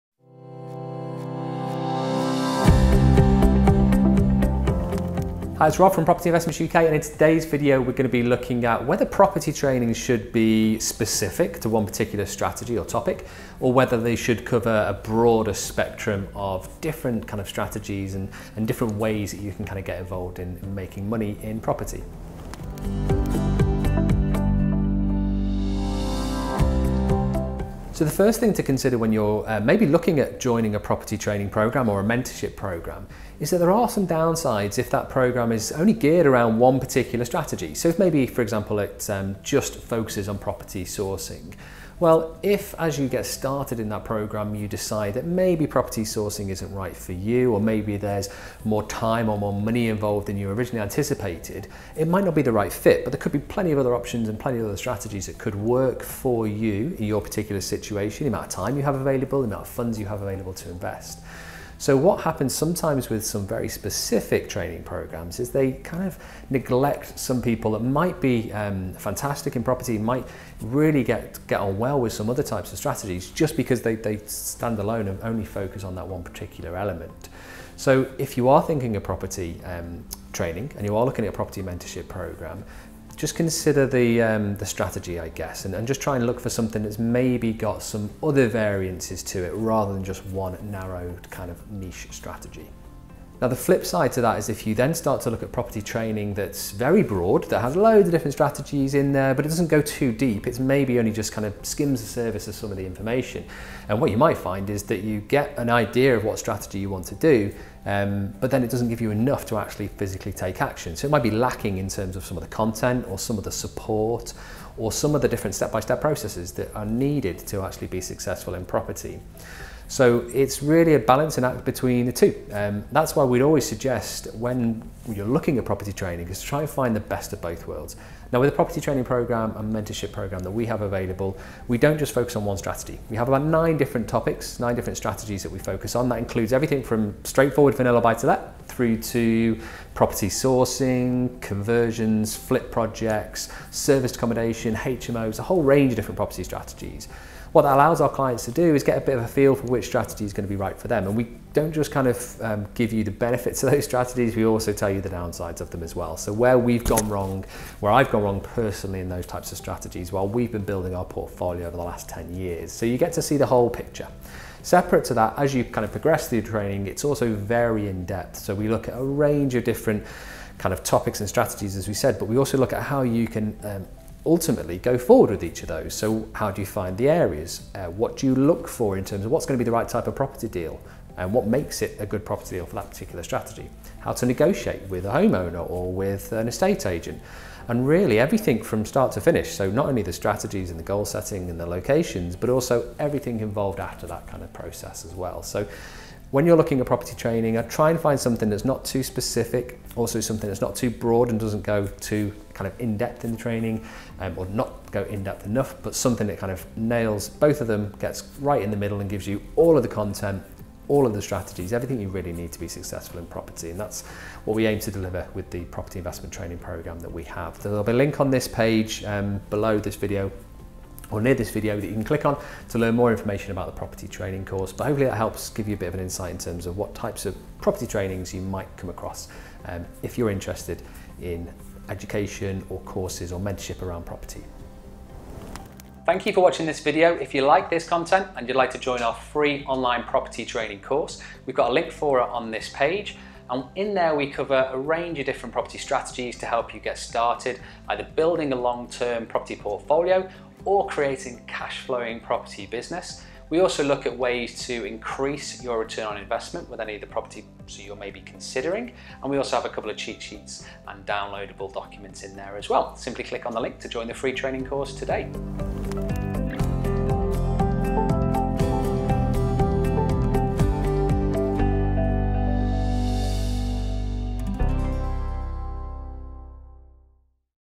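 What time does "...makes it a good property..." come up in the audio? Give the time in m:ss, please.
3:01.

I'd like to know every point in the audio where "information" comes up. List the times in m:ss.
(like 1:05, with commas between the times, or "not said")
1:42, 3:43.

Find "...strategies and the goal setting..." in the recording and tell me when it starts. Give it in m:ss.
3:10.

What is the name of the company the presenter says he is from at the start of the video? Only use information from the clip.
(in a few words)
Property Investments UK.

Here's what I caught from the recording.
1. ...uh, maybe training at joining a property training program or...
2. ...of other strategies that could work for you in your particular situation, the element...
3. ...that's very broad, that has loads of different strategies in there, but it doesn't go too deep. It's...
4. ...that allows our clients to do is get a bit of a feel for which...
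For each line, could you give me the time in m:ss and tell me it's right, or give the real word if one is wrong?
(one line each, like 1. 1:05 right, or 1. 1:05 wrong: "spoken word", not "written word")
1. 0:29 wrong: "looking", not "training"
2. 0:54 wrong: "amount", not "element"
3. 1:36 right
4. 2:27 right.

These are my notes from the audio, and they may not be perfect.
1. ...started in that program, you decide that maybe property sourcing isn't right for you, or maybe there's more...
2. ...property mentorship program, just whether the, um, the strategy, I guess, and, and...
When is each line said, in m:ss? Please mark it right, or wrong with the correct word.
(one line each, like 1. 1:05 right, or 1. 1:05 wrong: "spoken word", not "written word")
1. 0:43 right
2. 1:21 wrong: "consider", not "whether".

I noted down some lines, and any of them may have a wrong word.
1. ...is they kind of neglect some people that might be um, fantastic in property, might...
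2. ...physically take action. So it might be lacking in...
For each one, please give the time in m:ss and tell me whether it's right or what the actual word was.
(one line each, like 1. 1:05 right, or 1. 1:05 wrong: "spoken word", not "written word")
1. 1:05 right
2. 1:49 right.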